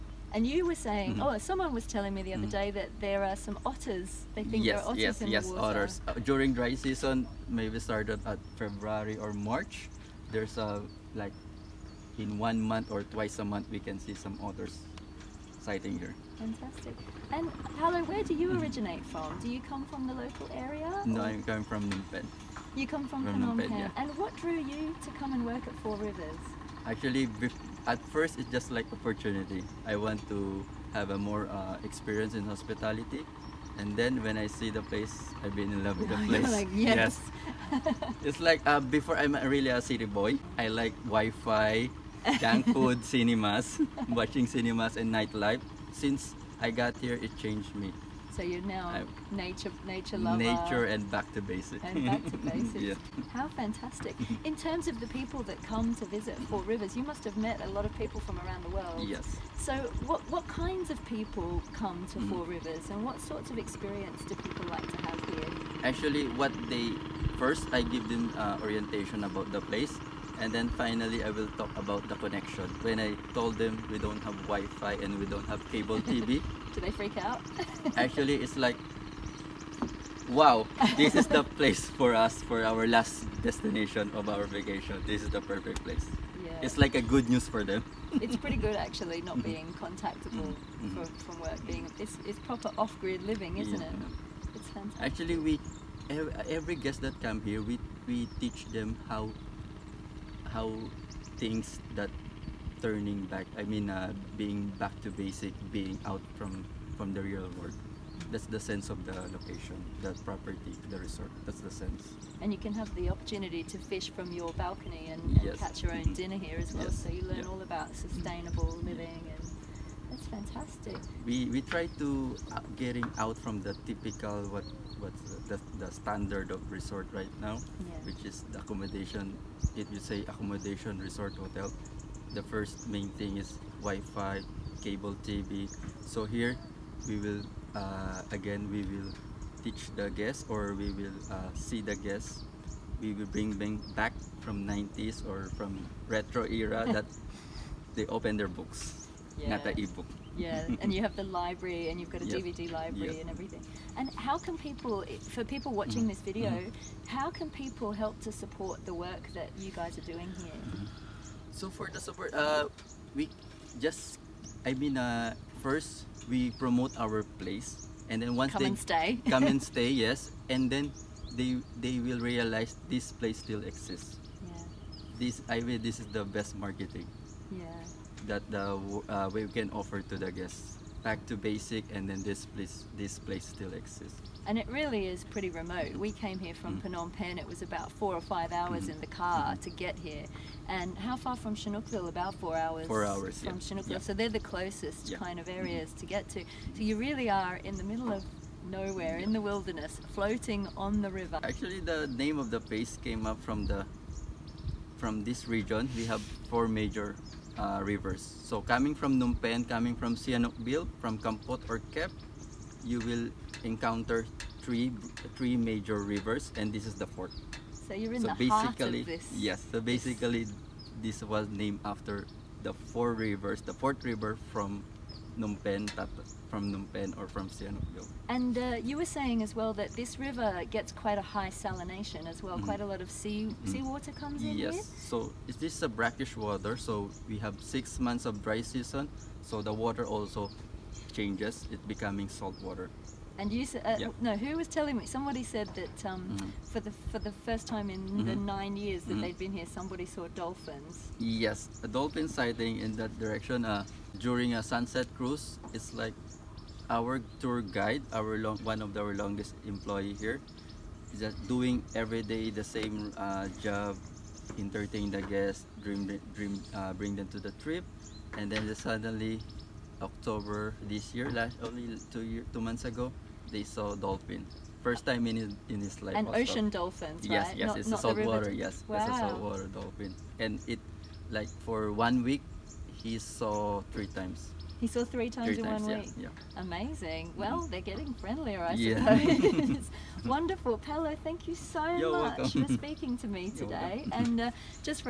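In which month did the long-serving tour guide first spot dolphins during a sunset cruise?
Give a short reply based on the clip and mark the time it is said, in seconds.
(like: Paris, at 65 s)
October, at 270 s.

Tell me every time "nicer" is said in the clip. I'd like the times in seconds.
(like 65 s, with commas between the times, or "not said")
not said.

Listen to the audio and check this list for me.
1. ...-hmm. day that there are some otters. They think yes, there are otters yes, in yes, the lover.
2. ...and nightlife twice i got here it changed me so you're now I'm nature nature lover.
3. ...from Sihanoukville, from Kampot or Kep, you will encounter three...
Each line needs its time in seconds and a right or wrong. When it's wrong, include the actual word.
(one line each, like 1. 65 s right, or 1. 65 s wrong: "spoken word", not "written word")
1. 2 s wrong: "water", not "lover"
2. 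44 s wrong: "since", not "twice"
3. 209 s right.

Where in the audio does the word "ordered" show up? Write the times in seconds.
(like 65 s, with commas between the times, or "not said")
not said.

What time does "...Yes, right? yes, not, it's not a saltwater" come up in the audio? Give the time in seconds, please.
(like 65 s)
277 s.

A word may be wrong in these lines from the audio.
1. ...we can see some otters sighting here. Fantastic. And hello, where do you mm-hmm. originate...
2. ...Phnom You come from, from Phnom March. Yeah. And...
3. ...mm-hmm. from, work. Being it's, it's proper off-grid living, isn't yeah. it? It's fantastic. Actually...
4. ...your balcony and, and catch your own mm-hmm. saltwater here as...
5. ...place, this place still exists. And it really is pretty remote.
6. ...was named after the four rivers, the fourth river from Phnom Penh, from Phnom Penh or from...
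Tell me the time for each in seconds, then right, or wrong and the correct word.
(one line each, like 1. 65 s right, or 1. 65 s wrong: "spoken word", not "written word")
1. 13 s right
2. 22 s wrong: "Penh", not "March"
3. 91 s right
4. 114 s wrong: "dinner", not "saltwater"
5. 182 s right
6. 221 s right.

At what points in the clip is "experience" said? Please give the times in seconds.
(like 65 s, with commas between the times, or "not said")
31 s, 63 s.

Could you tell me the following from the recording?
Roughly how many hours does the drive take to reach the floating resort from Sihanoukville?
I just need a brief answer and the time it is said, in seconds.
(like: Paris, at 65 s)
4, at 192 s.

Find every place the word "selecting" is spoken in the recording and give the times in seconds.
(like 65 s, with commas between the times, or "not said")
not said.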